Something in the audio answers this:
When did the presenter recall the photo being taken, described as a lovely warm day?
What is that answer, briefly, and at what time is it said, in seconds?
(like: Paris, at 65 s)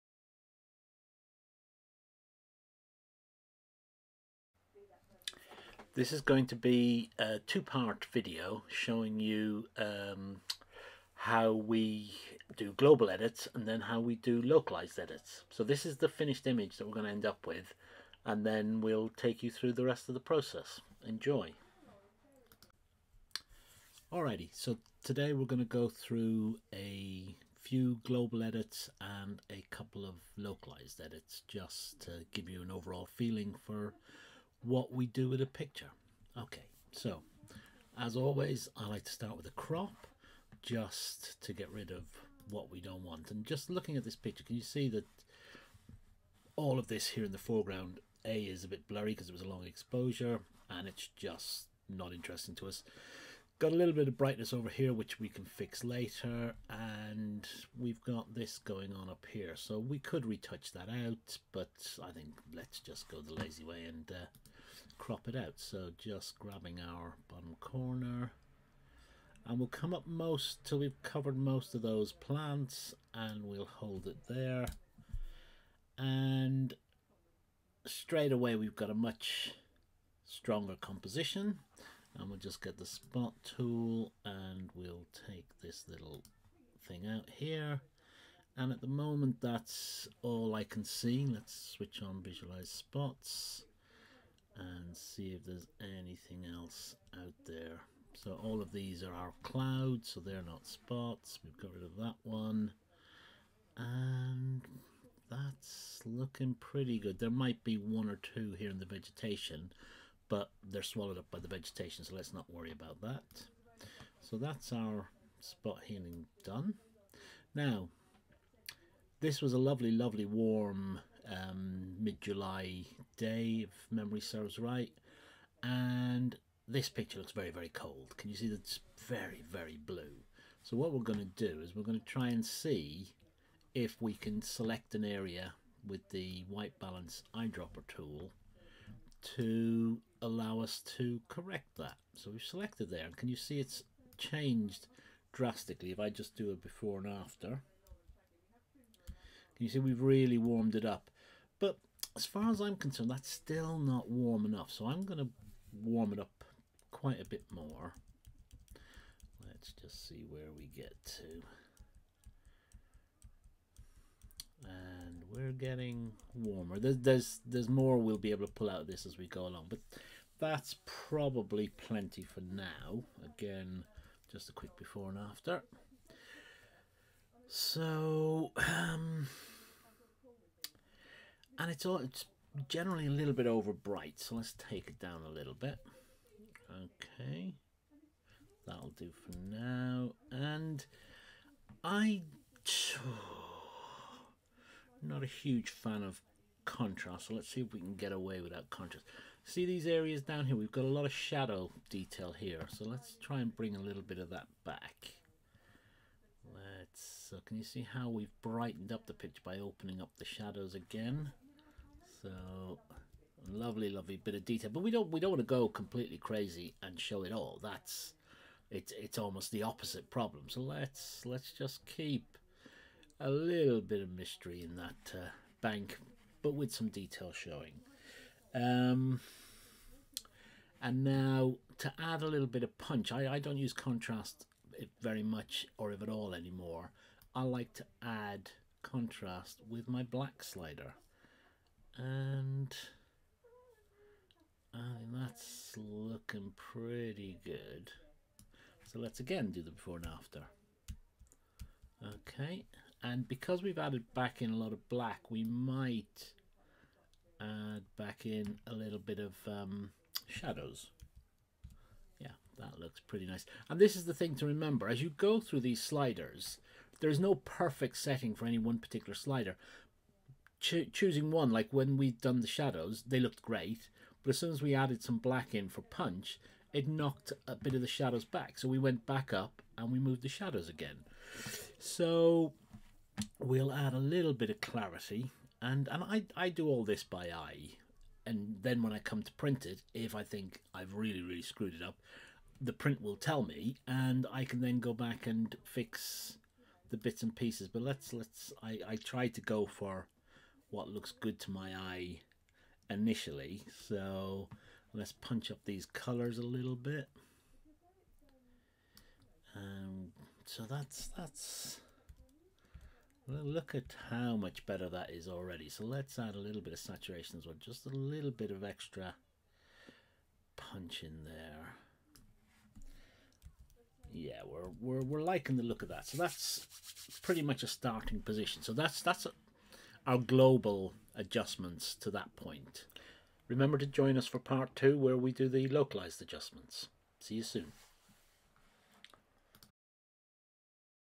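mid July, at 121 s.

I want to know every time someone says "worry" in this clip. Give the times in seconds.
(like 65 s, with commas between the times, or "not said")
112 s.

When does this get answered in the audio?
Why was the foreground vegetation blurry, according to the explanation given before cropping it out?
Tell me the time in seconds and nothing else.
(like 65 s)
49 s.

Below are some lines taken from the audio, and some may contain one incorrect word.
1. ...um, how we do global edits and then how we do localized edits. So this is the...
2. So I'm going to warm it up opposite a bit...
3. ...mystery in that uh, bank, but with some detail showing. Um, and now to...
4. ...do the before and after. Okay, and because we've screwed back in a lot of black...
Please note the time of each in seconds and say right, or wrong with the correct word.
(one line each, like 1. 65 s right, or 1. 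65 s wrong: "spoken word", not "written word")
1. 9 s right
2. 154 s wrong: "quite", not "opposite"
3. 224 s right
4. 249 s wrong: "added", not "screwed".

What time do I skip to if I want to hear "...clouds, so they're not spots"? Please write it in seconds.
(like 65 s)
99 s.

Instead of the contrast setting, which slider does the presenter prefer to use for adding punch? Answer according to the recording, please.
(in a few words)
black slider.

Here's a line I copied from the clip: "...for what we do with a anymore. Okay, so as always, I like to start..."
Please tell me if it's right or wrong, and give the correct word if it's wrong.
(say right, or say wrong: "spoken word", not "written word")
wrong: "picture", not "anymore".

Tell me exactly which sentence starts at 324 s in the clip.
Yeah, we're we're we're liking the look of that.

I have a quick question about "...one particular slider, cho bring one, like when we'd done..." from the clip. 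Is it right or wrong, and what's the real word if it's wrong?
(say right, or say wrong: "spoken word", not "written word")
wrong: "choosing", not "bring".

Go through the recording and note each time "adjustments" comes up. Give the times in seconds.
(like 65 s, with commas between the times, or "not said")
331 s, 336 s.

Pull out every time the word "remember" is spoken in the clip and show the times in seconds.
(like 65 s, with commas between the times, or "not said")
264 s, 333 s.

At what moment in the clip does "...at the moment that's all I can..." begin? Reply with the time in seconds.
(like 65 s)
88 s.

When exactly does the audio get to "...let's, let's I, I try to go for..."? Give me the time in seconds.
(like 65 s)
297 s.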